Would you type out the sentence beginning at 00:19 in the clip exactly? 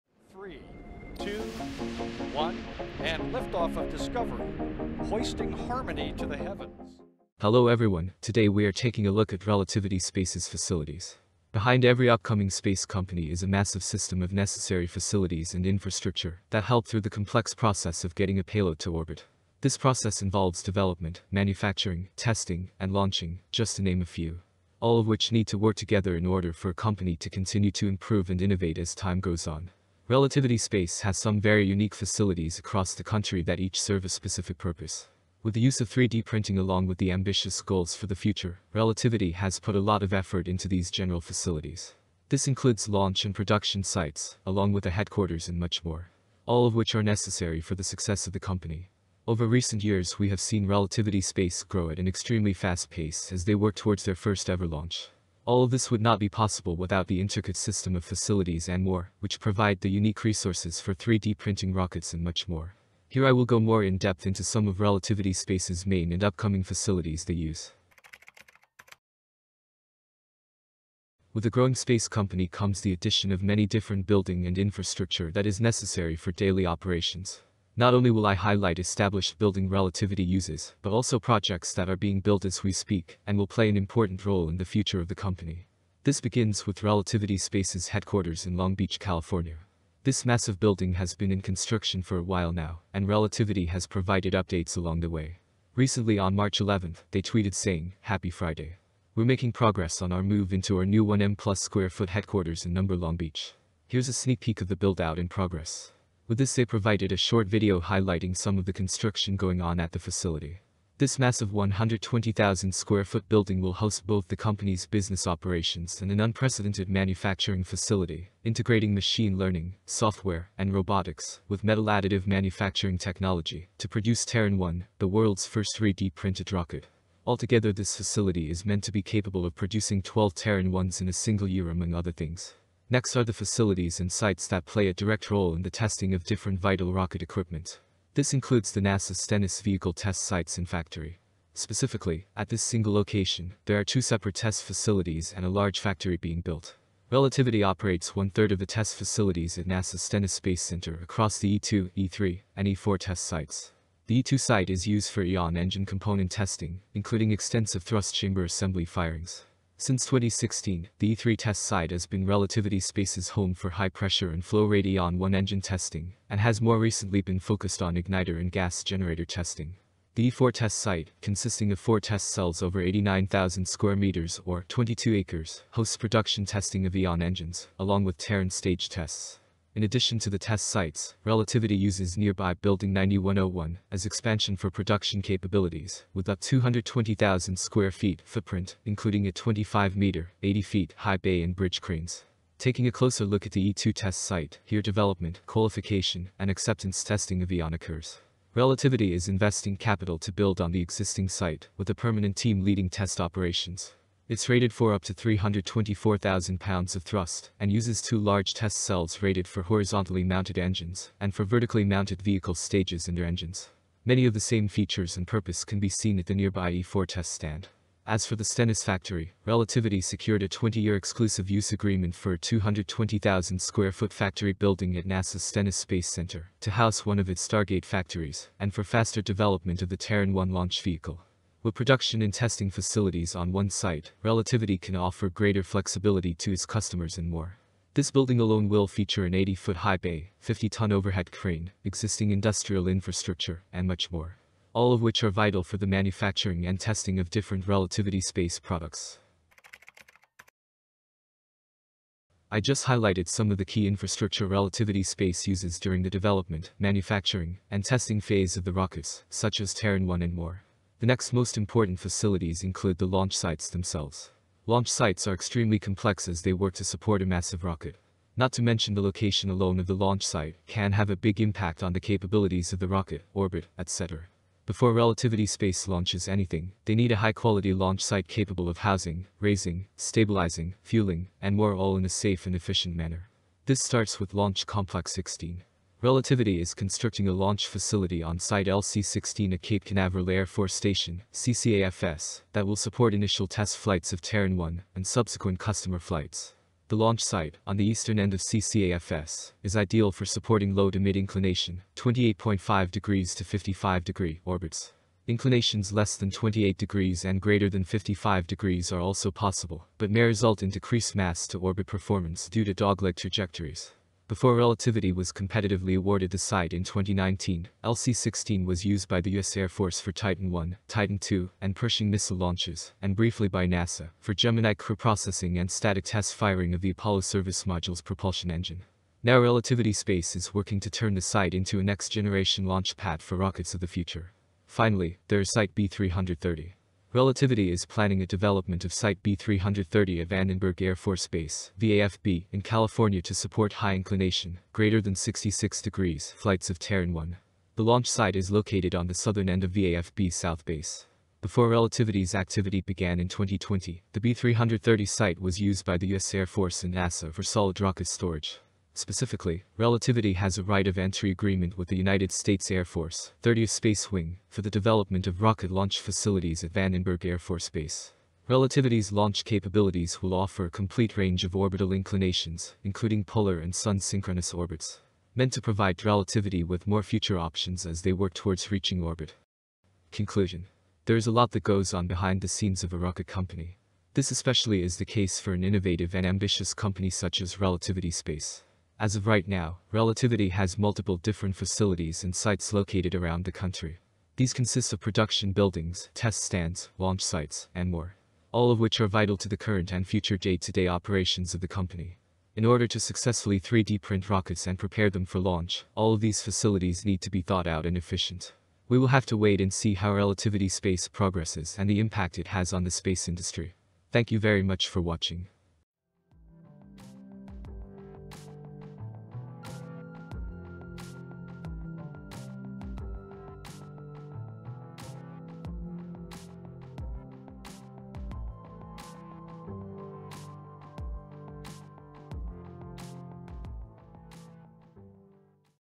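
This process involves development, manufacturing, testing, and launching, just to name a few.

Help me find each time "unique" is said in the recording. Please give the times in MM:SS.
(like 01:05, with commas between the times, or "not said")
00:31, 00:59.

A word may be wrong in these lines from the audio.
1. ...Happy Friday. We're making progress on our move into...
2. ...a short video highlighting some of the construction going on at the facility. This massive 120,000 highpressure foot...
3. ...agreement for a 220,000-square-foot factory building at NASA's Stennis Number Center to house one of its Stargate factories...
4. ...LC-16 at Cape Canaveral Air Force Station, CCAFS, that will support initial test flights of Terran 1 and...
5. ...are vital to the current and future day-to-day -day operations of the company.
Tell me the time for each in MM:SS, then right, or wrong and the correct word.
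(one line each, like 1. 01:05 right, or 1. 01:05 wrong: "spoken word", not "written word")
1. 01:38 right
2. 01:47 wrong: "square", not "highpressure"
3. 03:41 wrong: "Space", not "Number"
4. 04:48 right
5. 06:39 right.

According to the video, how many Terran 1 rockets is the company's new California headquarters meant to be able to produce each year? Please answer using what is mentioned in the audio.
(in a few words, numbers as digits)
12.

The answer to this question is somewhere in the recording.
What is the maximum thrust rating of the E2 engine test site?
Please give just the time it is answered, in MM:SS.
03:25.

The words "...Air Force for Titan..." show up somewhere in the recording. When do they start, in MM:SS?
05:19.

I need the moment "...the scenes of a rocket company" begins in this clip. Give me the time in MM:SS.
06:22.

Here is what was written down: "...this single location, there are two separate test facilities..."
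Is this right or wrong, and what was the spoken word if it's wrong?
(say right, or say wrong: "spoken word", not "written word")
right.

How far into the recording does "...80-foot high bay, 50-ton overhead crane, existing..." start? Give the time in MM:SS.
03:59.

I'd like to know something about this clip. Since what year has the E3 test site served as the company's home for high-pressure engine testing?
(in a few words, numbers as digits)
2016.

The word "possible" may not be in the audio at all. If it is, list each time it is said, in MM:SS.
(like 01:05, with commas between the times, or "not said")
00:56, 05:09.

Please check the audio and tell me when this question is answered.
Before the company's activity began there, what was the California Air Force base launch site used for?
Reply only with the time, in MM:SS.
05:57.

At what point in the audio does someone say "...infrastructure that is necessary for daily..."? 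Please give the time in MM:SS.
01:14.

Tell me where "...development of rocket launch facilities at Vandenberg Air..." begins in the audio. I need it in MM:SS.
06:04.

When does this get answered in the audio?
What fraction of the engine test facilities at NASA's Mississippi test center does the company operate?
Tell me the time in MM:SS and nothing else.
02:28.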